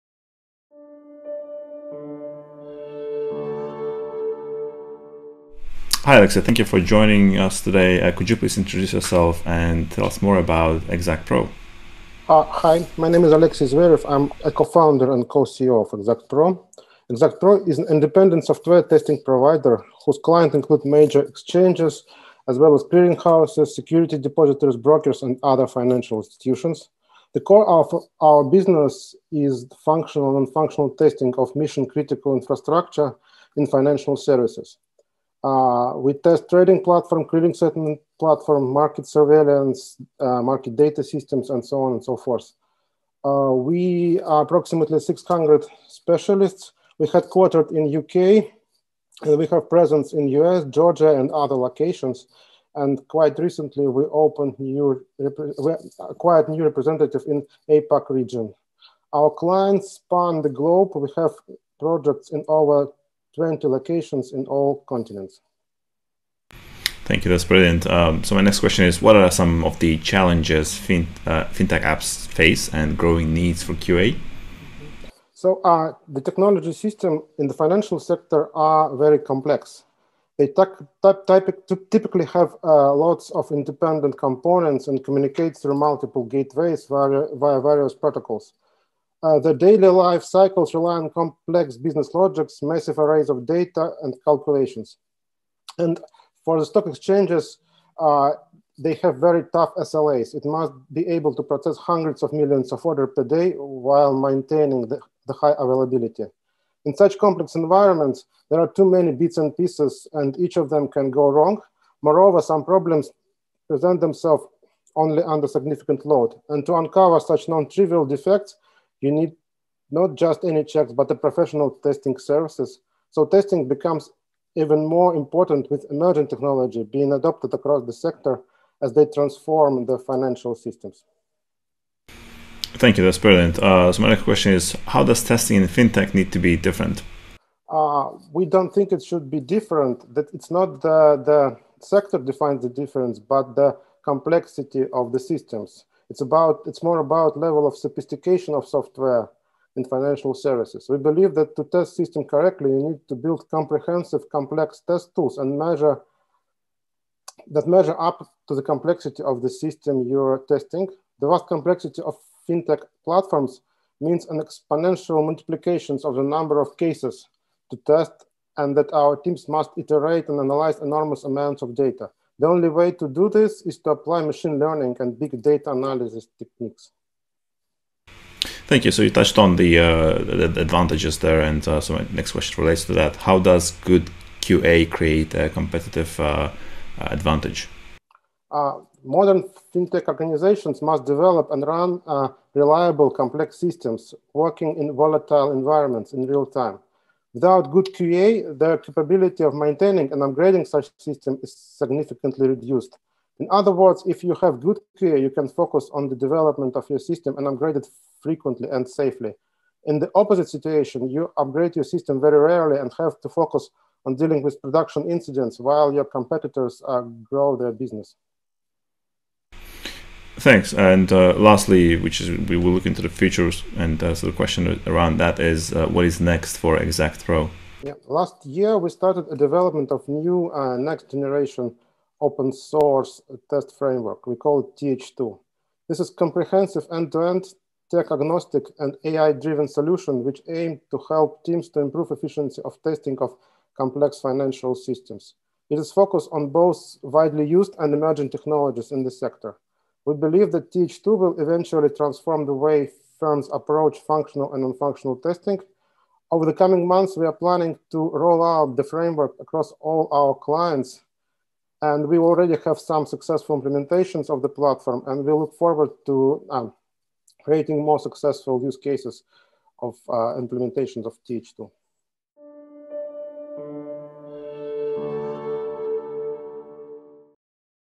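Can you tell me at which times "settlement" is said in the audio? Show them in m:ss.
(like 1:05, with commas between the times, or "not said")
0:37.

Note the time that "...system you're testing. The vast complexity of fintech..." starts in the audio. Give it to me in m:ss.
2:39.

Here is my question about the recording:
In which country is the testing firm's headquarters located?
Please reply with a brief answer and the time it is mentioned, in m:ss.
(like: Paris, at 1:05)
UK, at 0:47.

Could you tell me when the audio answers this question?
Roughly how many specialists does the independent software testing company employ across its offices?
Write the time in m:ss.
0:44.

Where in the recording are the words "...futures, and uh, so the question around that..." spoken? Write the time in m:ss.
3:43.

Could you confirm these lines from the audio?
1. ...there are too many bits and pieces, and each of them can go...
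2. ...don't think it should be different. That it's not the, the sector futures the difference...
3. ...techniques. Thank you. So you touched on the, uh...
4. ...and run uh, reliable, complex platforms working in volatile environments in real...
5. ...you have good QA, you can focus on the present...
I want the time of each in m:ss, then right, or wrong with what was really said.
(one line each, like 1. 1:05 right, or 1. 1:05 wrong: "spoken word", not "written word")
1. 1:48 right
2. 2:18 wrong: "defines", not "futures"
3. 2:56 right
4. 3:11 wrong: "systems", not "platforms"
5. 3:24 wrong: "development", not "present".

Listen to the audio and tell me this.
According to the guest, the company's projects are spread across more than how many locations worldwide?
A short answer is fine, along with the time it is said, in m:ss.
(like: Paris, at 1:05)
20, at 1:03.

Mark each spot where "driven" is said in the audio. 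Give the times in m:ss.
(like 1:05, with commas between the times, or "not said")
3:59.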